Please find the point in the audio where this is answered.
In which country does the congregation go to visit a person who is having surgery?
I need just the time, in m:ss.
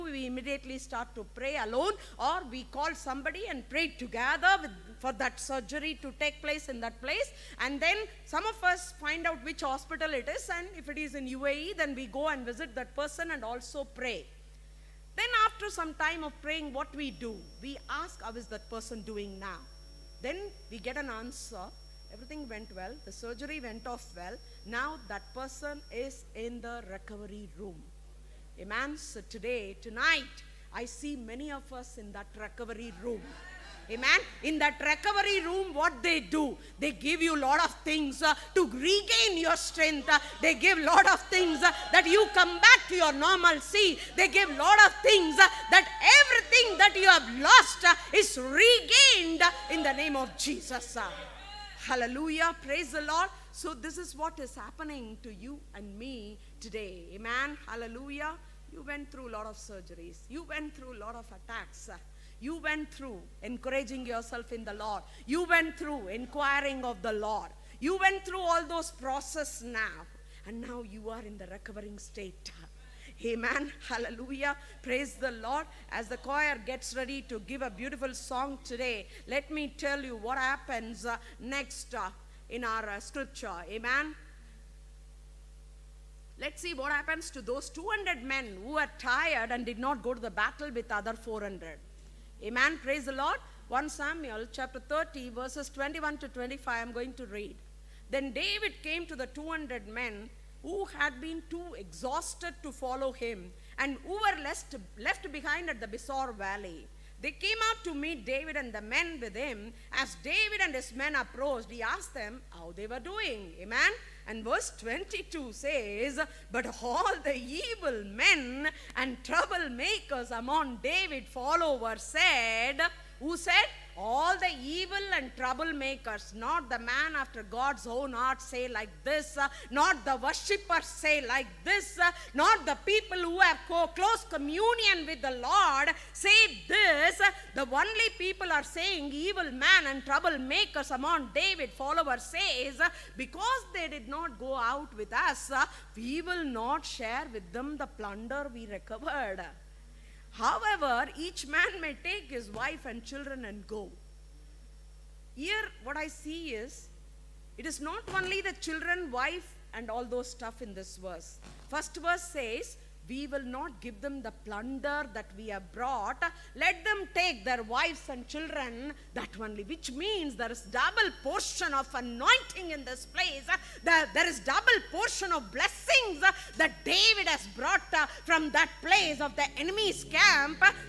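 0:11.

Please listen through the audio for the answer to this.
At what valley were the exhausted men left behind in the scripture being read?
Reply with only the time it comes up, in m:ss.
1:45.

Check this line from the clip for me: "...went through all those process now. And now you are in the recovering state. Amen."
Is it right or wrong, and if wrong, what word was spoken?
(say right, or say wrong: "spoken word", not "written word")
right.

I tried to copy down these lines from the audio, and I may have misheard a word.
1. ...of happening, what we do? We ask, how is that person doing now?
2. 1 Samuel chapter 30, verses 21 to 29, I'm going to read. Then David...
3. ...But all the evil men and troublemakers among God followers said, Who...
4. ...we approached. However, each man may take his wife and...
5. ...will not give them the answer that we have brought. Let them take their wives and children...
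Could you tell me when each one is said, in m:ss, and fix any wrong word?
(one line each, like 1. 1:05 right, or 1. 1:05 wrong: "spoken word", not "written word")
1. 0:16 wrong: "praying", not "happening"
2. 1:33 wrong: "25", not "29"
3. 1:56 wrong: "David", not "God"
4. 2:28 wrong: "recovered", not "approached"
5. 2:43 wrong: "plunder", not "answer".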